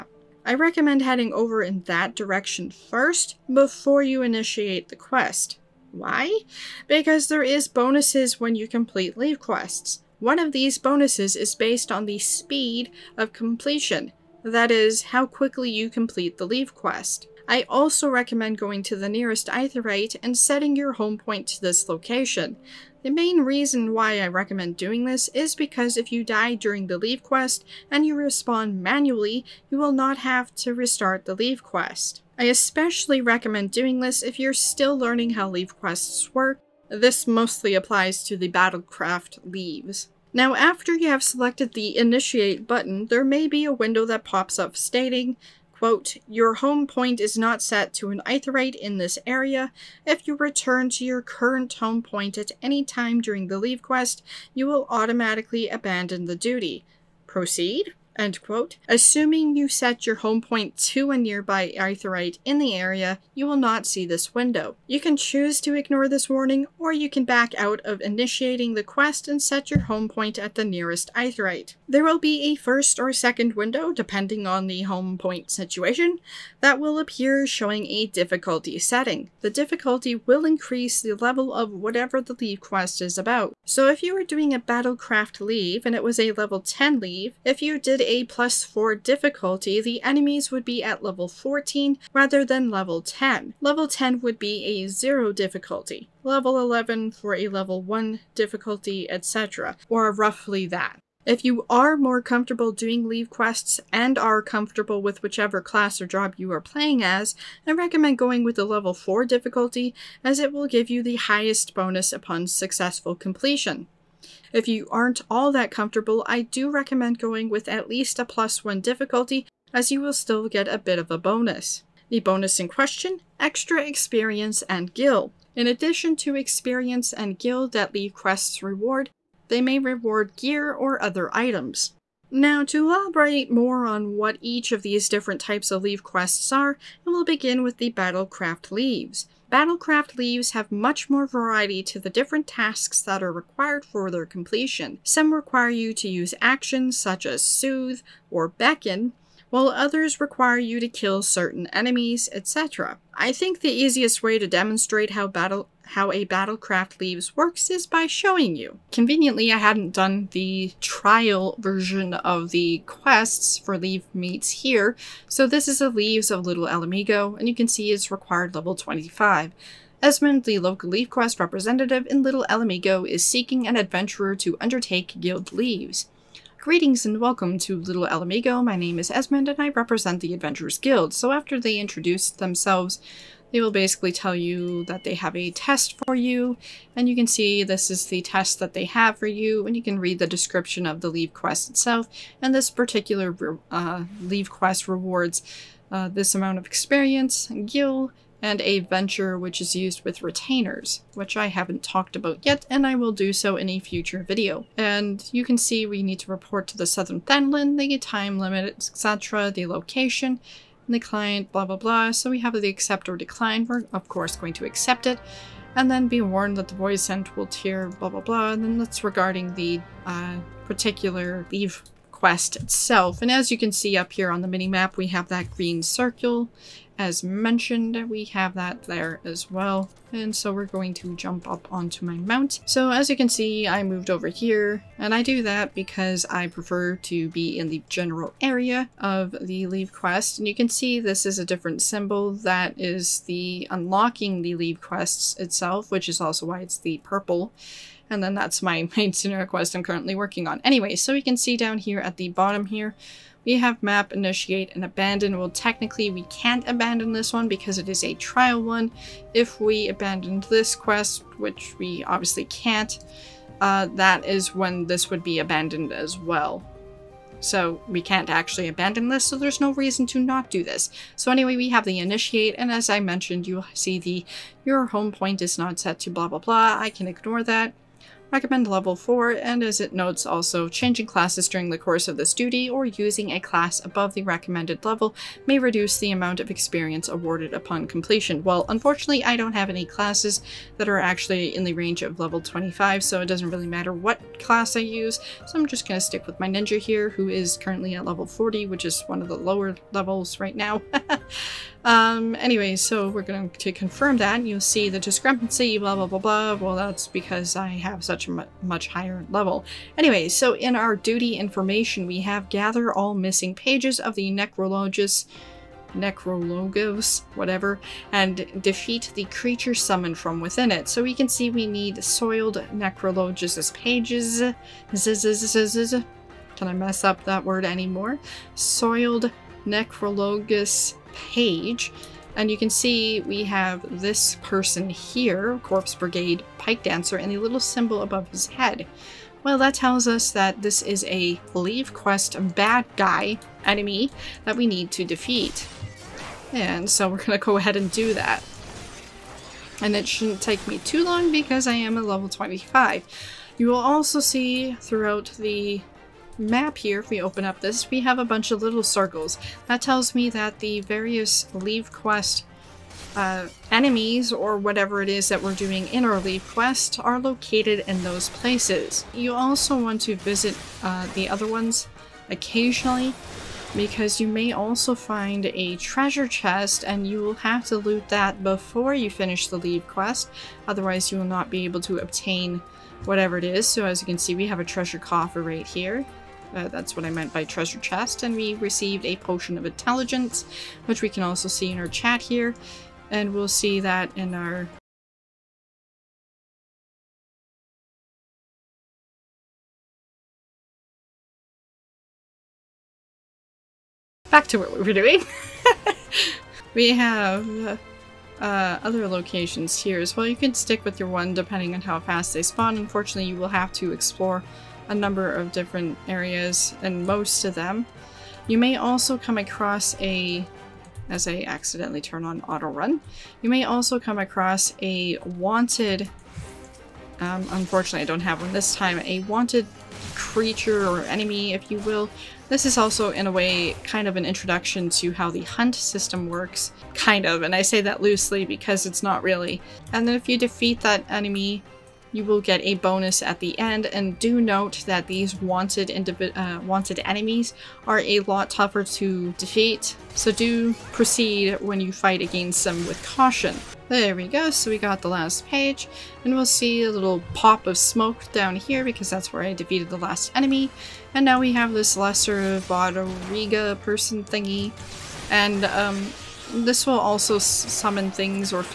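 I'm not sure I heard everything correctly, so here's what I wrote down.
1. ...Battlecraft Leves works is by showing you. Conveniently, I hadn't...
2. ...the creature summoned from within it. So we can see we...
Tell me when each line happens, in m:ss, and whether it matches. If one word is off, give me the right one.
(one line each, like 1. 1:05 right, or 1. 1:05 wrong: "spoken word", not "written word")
1. 2:36 right
2. 5:19 right.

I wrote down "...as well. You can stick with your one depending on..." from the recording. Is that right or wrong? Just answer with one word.
right.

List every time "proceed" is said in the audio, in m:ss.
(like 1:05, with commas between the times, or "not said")
0:57, 7:30.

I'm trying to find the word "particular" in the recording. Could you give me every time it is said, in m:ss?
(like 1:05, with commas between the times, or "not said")
3:12, 3:40.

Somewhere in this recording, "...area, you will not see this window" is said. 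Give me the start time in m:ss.
1:02.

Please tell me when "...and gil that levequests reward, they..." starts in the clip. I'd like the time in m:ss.
2:07.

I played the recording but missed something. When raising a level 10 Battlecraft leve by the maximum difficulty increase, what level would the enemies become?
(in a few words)
14.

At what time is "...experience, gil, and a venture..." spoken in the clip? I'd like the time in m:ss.
3:16.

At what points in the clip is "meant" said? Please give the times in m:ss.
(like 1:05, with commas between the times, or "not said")
6:27.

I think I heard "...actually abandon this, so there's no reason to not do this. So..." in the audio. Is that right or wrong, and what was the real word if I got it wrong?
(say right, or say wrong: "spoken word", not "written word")
right.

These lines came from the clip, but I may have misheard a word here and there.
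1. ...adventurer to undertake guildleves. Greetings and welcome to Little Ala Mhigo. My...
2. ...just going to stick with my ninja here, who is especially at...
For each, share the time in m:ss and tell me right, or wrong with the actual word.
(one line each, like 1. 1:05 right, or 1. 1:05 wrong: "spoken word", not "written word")
1. 2:53 right
2. 4:55 wrong: "currently", not "especially".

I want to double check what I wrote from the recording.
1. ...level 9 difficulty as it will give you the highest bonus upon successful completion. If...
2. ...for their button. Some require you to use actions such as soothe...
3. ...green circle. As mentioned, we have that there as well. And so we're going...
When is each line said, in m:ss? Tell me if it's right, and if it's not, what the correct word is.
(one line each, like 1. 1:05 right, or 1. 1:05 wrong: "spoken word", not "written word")
1. 1:48 wrong: "4", not "9"
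2. 2:23 wrong: "completion", not "button"
3. 3:45 right.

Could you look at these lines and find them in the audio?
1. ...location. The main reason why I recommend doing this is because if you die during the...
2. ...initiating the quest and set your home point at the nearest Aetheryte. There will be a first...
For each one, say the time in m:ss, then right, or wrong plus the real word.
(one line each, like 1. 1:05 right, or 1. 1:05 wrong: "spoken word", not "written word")
1. 0:21 right
2. 1:08 right.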